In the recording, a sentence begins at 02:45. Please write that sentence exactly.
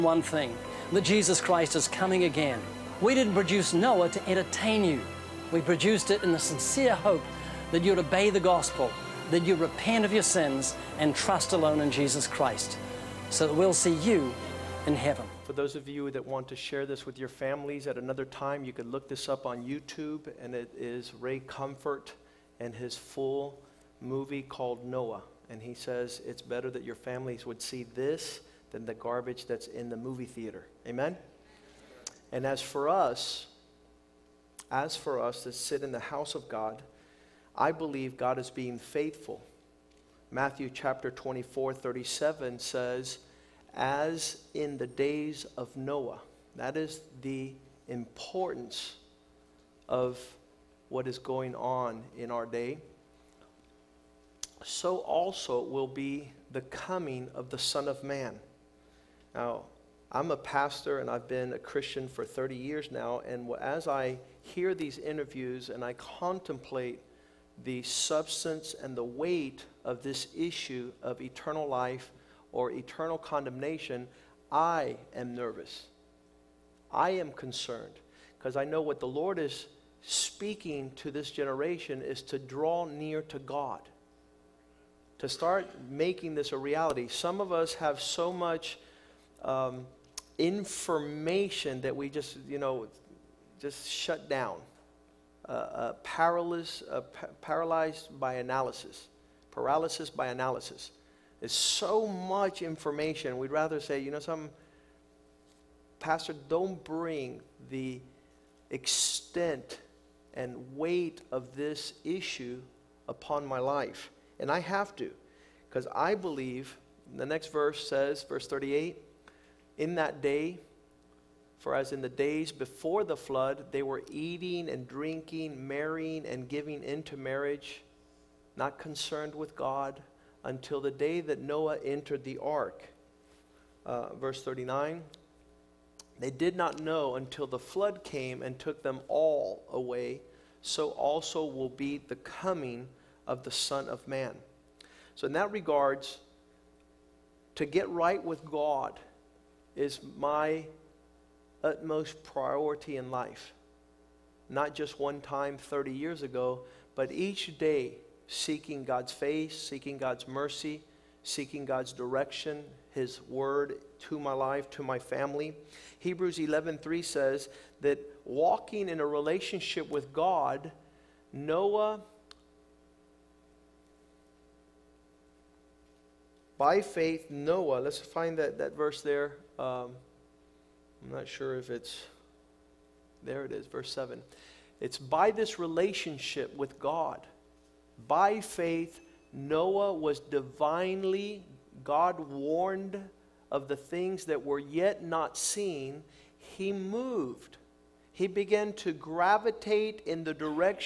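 Hebrews 11:3 says that walking in a relationship with God, Noah by faith Noah, let's find that, that verse there.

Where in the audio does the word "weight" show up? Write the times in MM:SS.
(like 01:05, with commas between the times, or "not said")
01:09, 01:50.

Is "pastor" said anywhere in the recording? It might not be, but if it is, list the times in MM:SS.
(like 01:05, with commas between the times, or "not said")
01:00, 01:45.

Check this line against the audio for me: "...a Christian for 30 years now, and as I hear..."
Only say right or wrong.
right.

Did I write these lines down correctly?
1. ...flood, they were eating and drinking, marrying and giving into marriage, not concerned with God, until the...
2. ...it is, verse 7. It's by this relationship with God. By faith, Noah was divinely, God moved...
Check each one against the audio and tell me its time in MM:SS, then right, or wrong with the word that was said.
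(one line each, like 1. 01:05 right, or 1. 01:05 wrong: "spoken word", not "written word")
1. 02:03 right
2. 03:03 wrong: "warned", not "moved".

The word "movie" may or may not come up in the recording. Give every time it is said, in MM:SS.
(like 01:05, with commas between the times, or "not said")
00:24, 00:29.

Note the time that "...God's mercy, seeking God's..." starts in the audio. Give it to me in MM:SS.
02:39.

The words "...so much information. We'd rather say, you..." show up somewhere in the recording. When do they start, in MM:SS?
01:41.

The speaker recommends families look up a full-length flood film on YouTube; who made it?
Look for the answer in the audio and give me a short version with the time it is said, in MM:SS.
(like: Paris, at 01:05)
Ray Comfort, at 00:21.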